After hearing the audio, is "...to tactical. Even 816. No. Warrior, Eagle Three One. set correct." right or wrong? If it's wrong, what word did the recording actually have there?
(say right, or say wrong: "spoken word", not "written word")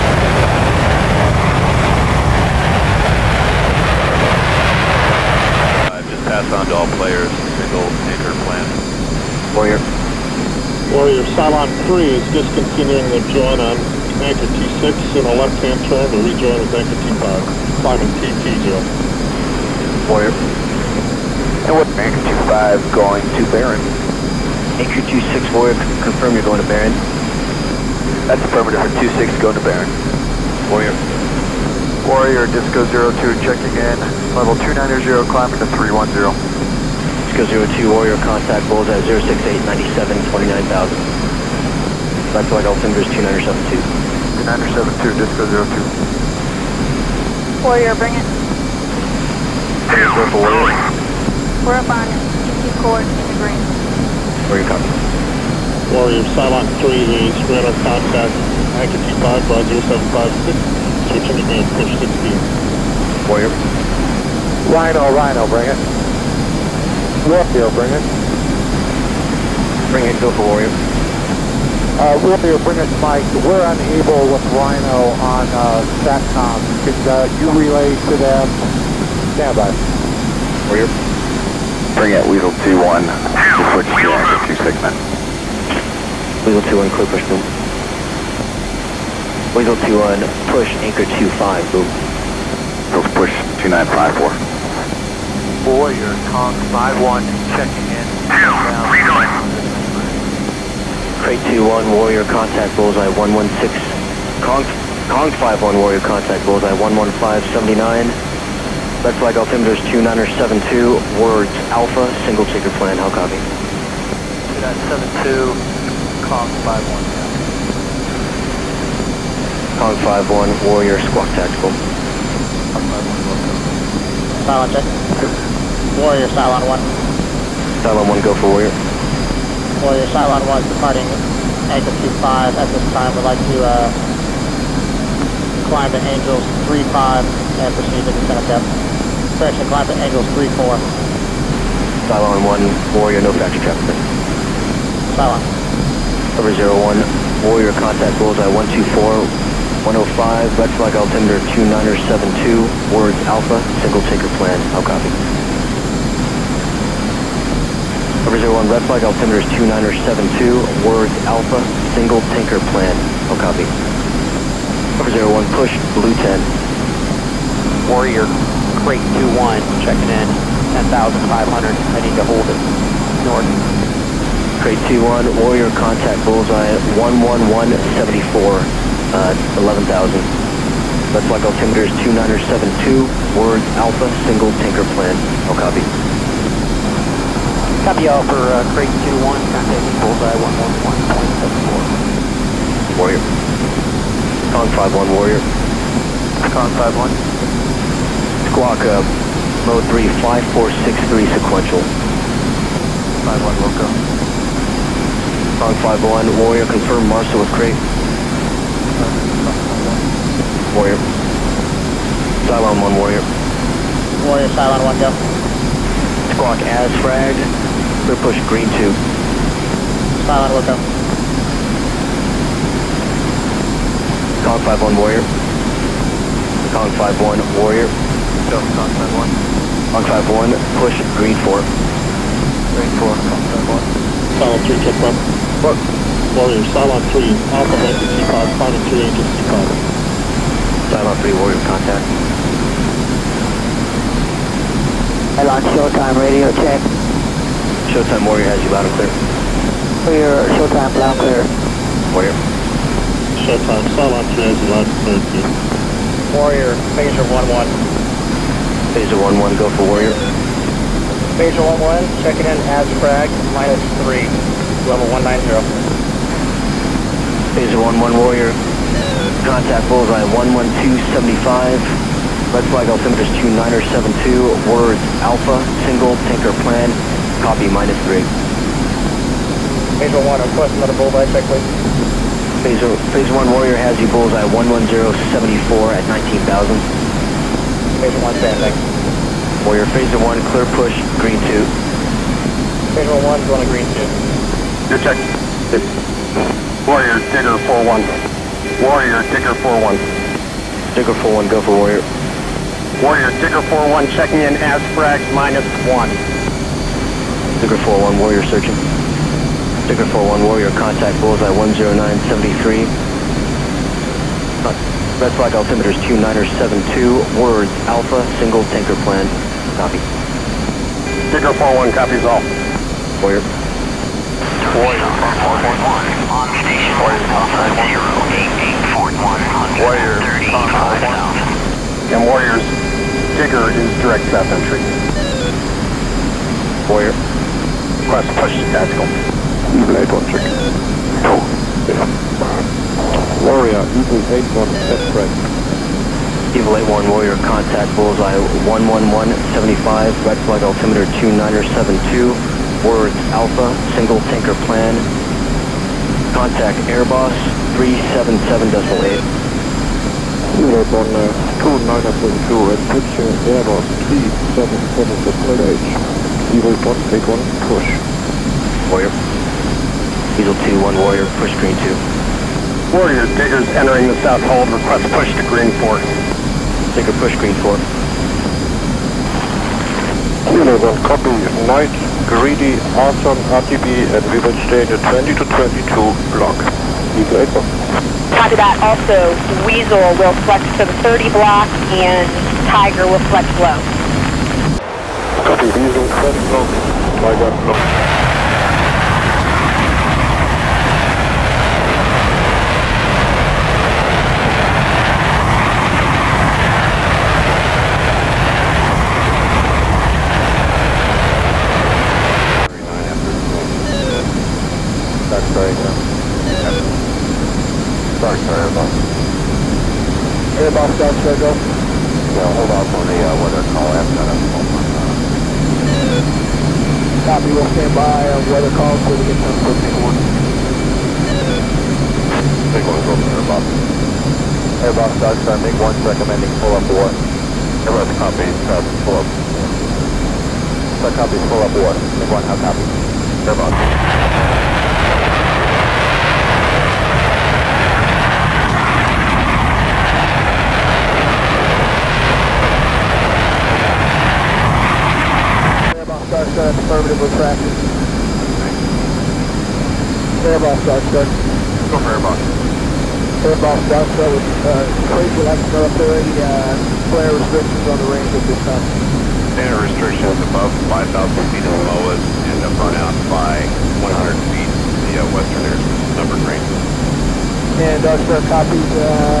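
wrong: "Eight", not "Three".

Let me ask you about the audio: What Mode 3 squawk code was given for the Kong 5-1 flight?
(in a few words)
5463.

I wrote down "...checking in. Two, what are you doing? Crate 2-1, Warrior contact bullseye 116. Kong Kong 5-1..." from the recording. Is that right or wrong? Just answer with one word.
right.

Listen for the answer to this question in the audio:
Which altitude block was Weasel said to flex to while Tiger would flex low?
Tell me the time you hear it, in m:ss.
6:31.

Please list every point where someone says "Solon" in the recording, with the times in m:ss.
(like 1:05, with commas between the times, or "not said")
4:13.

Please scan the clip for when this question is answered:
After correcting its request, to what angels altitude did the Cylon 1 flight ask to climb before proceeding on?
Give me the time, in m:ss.
2:20.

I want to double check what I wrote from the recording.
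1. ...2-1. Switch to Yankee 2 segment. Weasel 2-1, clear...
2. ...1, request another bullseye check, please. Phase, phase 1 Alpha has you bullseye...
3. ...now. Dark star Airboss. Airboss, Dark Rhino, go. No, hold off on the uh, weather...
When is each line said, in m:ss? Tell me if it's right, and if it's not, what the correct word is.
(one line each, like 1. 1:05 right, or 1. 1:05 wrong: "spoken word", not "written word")
1. 1:22 right
2. 4:40 wrong: "Warrior", not "Alpha"
3. 6:55 wrong: "Star", not "Rhino".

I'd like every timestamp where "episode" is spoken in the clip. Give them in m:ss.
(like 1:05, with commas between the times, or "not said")
not said.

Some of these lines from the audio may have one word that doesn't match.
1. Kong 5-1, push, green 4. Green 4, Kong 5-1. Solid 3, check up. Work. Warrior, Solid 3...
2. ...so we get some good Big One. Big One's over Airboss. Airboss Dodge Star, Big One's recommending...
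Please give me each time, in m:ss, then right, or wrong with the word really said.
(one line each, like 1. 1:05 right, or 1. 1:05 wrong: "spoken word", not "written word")
1. 3:49 right
2. 7:09 right.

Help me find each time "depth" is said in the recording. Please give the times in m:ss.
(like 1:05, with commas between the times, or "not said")
2:18.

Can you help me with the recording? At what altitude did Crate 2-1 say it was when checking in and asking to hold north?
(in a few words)
10,500.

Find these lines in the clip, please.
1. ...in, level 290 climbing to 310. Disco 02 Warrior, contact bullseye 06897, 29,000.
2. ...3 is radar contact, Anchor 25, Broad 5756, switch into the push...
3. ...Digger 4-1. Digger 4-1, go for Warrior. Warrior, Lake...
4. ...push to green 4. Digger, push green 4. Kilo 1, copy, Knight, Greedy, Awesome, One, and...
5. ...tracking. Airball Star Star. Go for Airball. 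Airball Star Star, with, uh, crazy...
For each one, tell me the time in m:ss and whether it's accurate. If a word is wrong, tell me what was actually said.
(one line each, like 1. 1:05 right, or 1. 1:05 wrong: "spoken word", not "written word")
1. 0:33 right
2. 0:56 wrong: "0756", not "5756"
3. 4:59 wrong: "Digger", not "Lake"
4. 6:15 wrong: "RTB", not "One"
5. 7:37 right.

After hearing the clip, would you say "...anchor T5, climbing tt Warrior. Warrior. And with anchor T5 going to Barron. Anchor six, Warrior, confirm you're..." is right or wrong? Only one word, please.
wrong.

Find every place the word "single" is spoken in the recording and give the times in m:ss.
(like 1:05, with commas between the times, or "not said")
1:52, 2:33, 2:41, 3:04, 4:35, 5:18, 5:53.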